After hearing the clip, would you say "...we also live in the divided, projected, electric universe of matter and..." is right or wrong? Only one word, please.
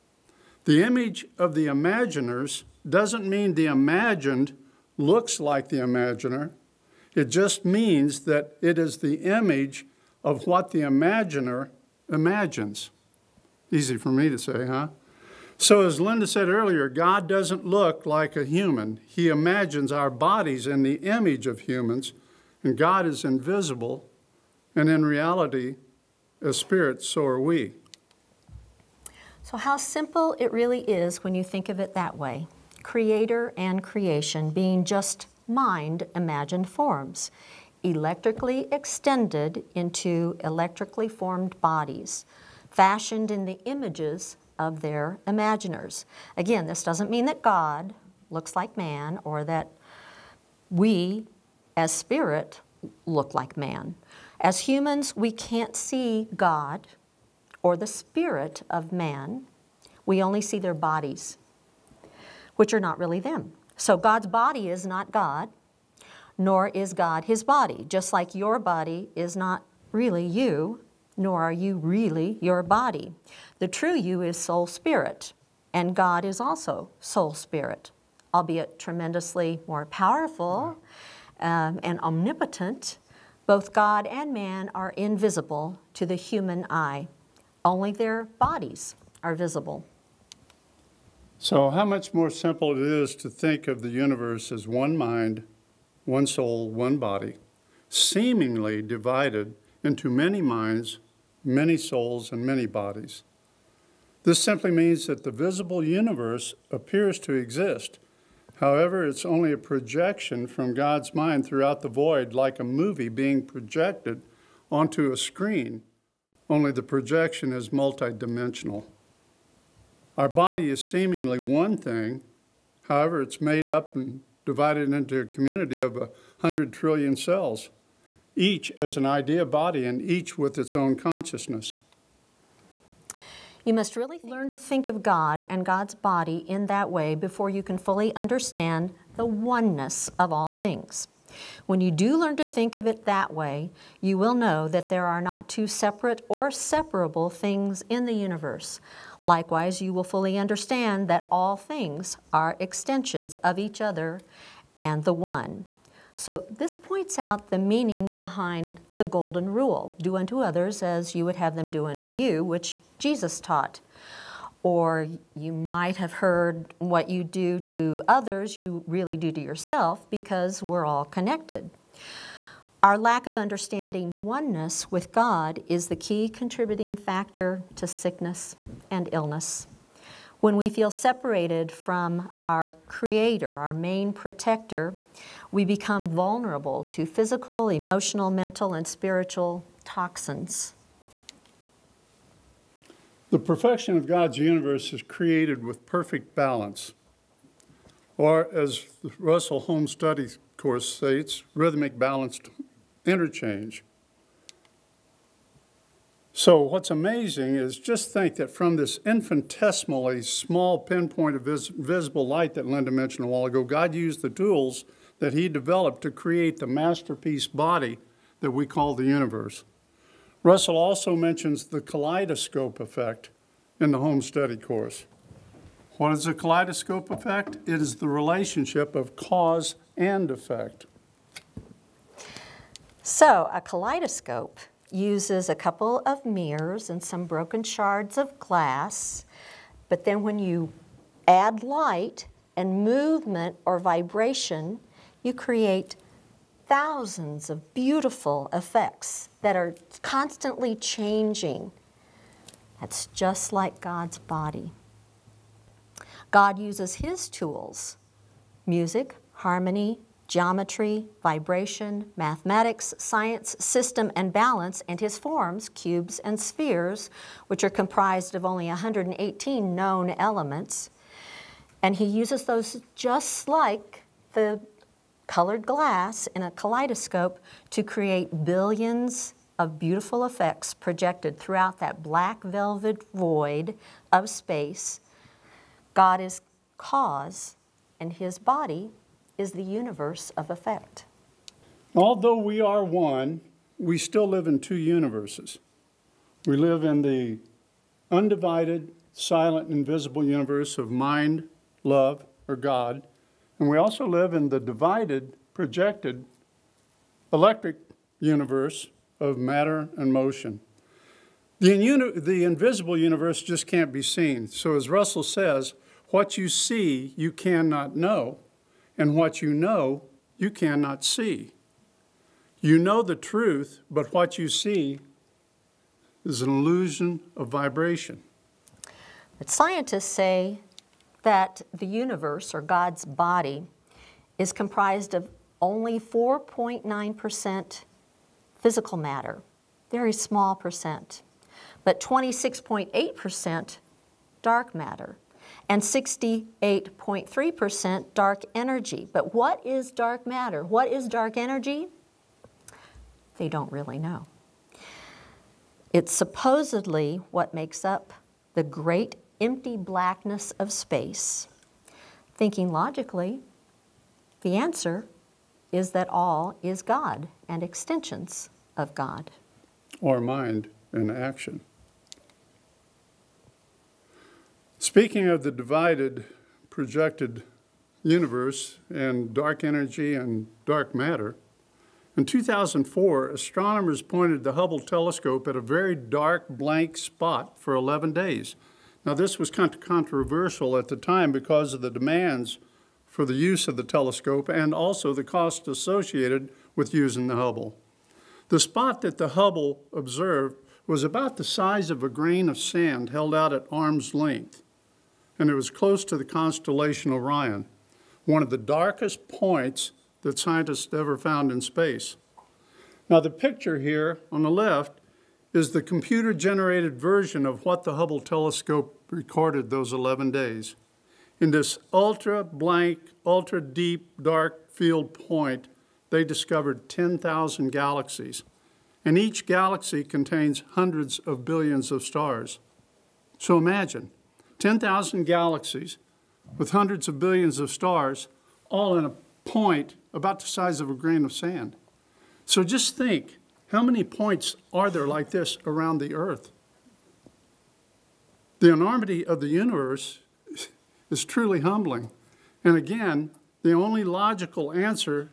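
right.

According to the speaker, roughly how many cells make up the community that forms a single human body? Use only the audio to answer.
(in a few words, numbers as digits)
100 trillion.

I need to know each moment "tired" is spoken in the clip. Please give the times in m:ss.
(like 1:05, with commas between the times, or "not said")
not said.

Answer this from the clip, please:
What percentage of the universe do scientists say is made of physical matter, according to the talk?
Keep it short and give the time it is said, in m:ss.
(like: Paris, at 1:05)
4.9%, at 5:35.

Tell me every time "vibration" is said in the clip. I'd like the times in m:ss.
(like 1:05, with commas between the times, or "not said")
4:03, 4:21, 5:27.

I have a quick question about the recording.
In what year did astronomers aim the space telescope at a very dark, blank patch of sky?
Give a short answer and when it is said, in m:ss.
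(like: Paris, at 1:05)
2004, at 6:22.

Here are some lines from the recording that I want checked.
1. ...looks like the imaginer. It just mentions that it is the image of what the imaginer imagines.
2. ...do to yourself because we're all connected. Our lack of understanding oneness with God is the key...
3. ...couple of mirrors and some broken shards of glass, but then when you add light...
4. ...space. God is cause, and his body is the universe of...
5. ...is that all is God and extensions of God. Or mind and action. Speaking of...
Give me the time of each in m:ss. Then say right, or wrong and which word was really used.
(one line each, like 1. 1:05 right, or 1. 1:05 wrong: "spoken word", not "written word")
1. 0:04 wrong: "means", not "mentions"
2. 2:49 right
3. 3:55 right
4. 4:44 right
5. 6:05 right.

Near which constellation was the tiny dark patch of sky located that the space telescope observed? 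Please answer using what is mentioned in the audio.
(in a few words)
Orion.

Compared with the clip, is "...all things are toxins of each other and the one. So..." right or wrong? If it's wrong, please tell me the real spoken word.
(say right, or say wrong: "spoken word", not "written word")
wrong: "extensions", not "toxins".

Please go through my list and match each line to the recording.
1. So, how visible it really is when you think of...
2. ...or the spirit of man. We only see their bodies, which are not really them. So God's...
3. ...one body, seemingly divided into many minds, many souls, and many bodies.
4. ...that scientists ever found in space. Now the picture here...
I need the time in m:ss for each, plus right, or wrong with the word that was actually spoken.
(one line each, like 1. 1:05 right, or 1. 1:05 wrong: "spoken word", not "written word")
1. 0:29 wrong: "simple", not "visible"
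2. 0:57 right
3. 1:36 right
4. 6:50 right.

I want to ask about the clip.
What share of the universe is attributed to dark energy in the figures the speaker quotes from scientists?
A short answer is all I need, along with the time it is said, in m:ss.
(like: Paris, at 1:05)
68.3%, at 5:45.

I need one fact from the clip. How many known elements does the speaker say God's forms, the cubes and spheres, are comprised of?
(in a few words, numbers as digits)
118.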